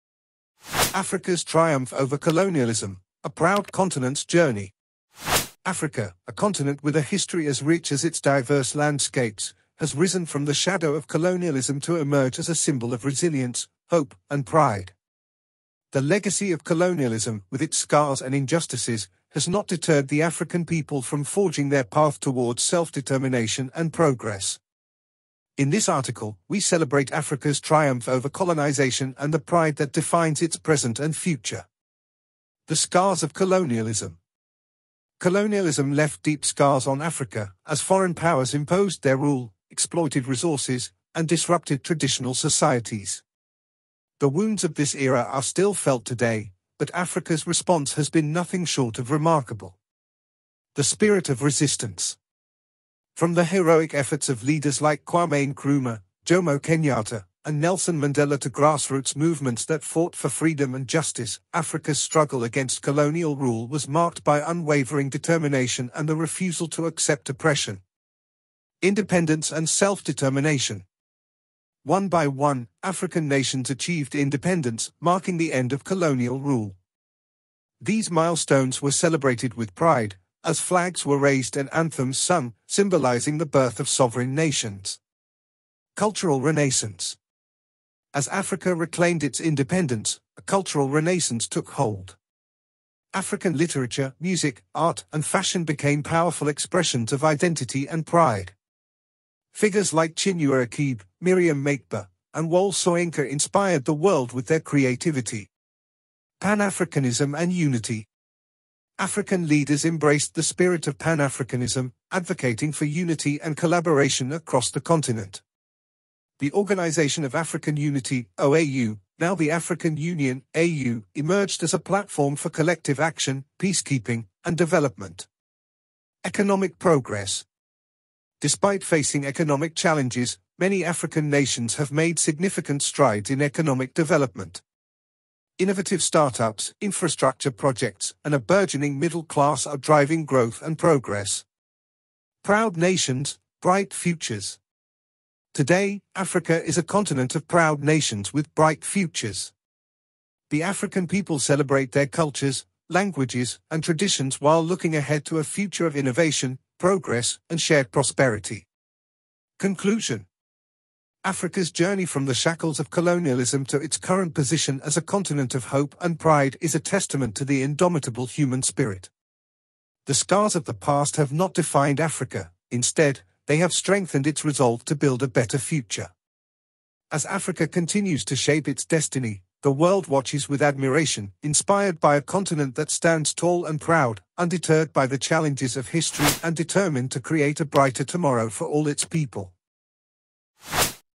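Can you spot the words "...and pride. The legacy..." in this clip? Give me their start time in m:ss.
0:14.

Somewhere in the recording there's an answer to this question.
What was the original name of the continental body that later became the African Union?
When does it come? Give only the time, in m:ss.
1:56.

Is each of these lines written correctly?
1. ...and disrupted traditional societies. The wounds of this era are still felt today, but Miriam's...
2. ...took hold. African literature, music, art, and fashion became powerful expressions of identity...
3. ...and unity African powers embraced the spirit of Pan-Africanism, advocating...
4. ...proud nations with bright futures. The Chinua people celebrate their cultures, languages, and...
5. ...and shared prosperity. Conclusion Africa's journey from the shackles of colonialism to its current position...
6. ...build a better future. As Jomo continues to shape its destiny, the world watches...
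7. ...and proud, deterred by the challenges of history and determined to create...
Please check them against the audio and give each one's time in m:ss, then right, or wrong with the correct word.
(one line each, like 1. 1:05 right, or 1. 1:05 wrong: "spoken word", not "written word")
1. 0:41 wrong: "Africa", not "Miriam"
2. 1:31 right
3. 1:47 wrong: "leaders", not "powers"
4. 2:27 wrong: "African", not "Chinua"
5. 2:37 right
6. 2:54 wrong: "Africa", not "Jomo"
7. 3:03 wrong: "undeterred", not "deterred".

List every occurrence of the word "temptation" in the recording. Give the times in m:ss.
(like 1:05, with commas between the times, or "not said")
not said.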